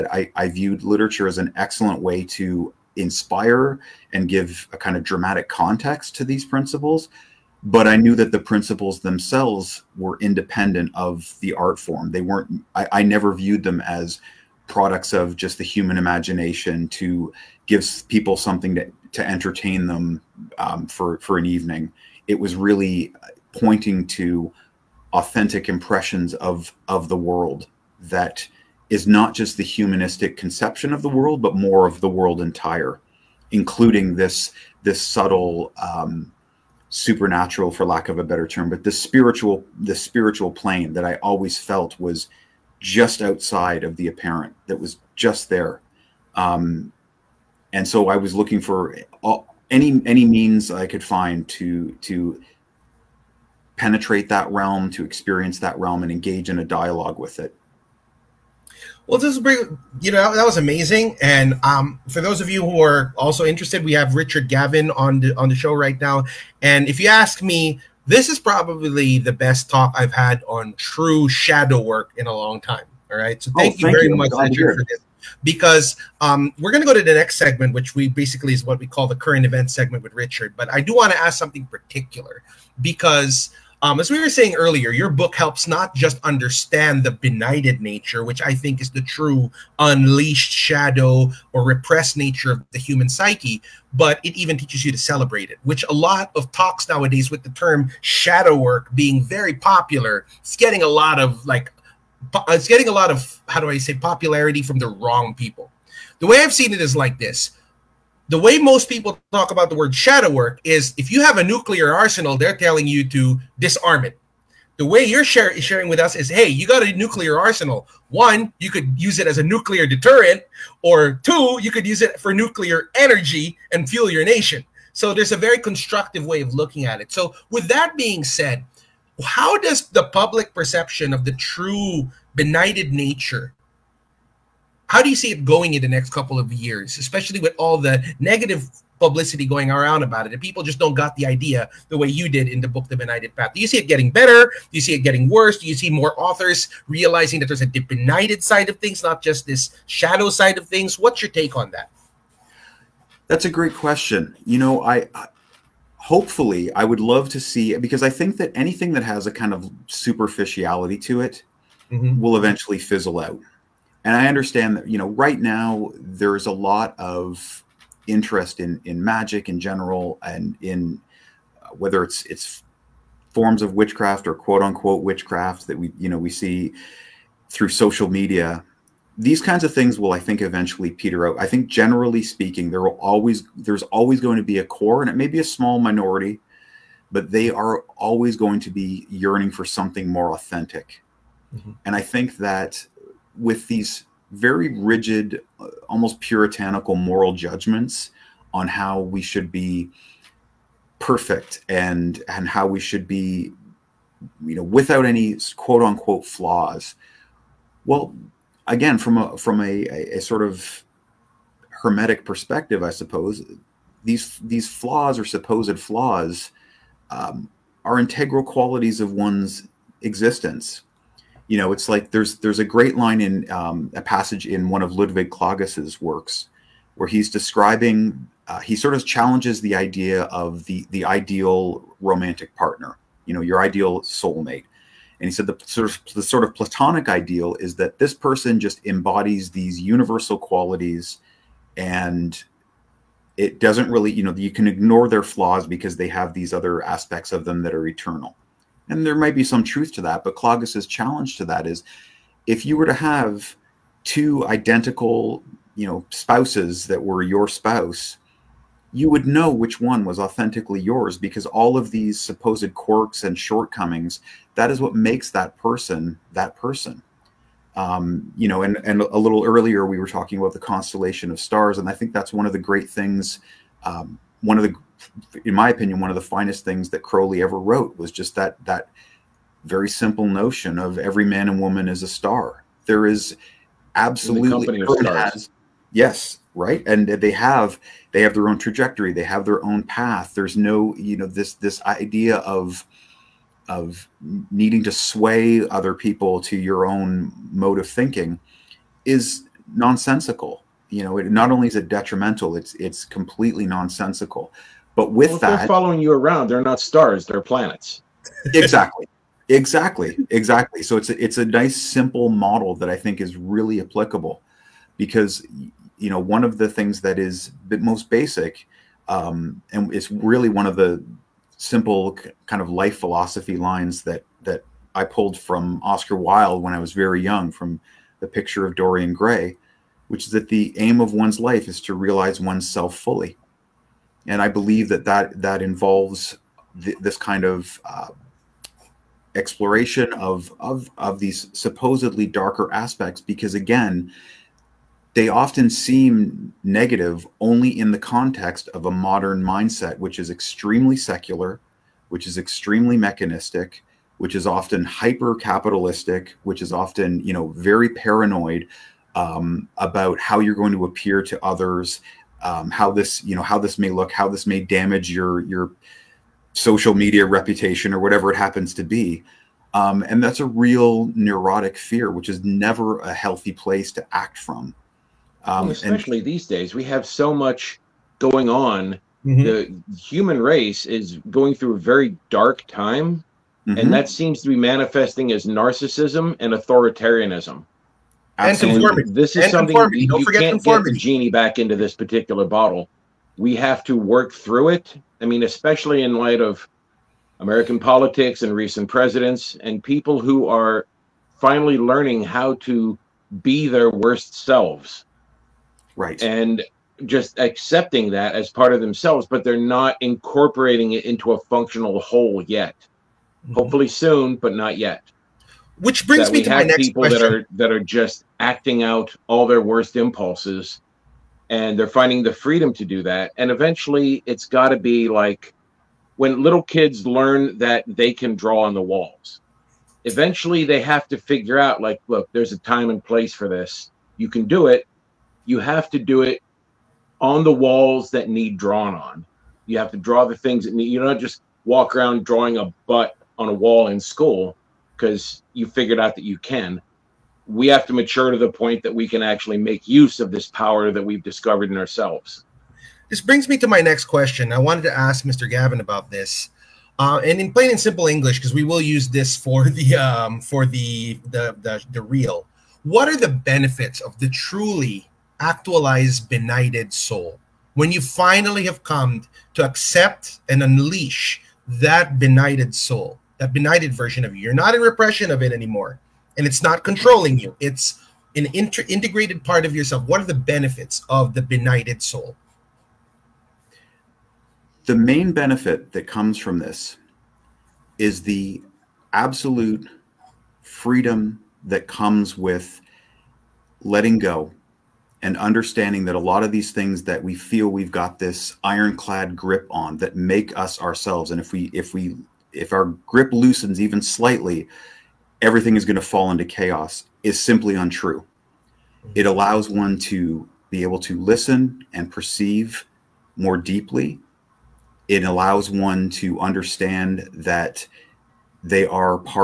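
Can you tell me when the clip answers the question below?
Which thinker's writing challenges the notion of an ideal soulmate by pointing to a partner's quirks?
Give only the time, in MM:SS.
03:44.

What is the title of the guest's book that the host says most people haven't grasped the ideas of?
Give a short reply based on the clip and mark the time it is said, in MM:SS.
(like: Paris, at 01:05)
The Benighted Path, at 02:22.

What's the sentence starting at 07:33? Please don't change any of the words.
This brings me to my next question.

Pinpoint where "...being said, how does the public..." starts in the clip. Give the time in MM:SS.
02:07.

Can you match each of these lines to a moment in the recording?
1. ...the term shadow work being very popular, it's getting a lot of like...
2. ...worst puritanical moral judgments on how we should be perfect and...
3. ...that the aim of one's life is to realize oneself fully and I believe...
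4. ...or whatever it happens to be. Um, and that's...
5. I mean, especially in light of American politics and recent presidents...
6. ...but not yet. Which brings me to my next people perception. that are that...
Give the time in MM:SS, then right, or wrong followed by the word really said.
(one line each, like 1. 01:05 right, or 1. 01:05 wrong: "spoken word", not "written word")
1. 01:37 right
2. 03:15 wrong: "almost", not "worst"
3. 05:30 right
4. 06:07 right
5. 06:35 right
6. 06:54 wrong: "question", not "perception".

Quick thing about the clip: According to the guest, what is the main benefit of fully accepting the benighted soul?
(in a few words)
Absolute freedom.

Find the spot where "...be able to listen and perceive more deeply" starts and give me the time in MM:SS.
08:30.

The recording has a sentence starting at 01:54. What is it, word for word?
The way you're share sharing with us is, hey, you got a nuclear arsenal.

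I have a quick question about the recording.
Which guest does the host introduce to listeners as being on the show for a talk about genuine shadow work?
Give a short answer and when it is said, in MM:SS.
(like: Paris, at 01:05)
Richard Gavin, at 01:04.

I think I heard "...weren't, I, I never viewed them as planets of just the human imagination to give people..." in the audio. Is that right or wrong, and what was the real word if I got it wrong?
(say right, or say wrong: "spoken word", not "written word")
wrong: "products", not "planets".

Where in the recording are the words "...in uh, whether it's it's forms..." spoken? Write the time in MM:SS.
02:50.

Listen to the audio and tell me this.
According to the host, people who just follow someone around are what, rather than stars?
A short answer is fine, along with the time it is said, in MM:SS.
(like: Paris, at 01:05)
Planets, at 05:07.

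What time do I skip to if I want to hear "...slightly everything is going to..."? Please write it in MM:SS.
08:24.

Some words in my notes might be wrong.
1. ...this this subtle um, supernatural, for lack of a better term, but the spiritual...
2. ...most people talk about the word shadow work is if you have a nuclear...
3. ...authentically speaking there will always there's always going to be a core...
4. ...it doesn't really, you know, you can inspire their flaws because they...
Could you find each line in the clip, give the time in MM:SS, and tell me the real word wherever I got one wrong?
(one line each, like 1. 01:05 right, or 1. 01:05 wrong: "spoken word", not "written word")
1. 00:34 right
2. 01:48 right
3. 03:01 wrong: "generally", not "authentically"
4. 04:03 wrong: "ignore", not "inspire".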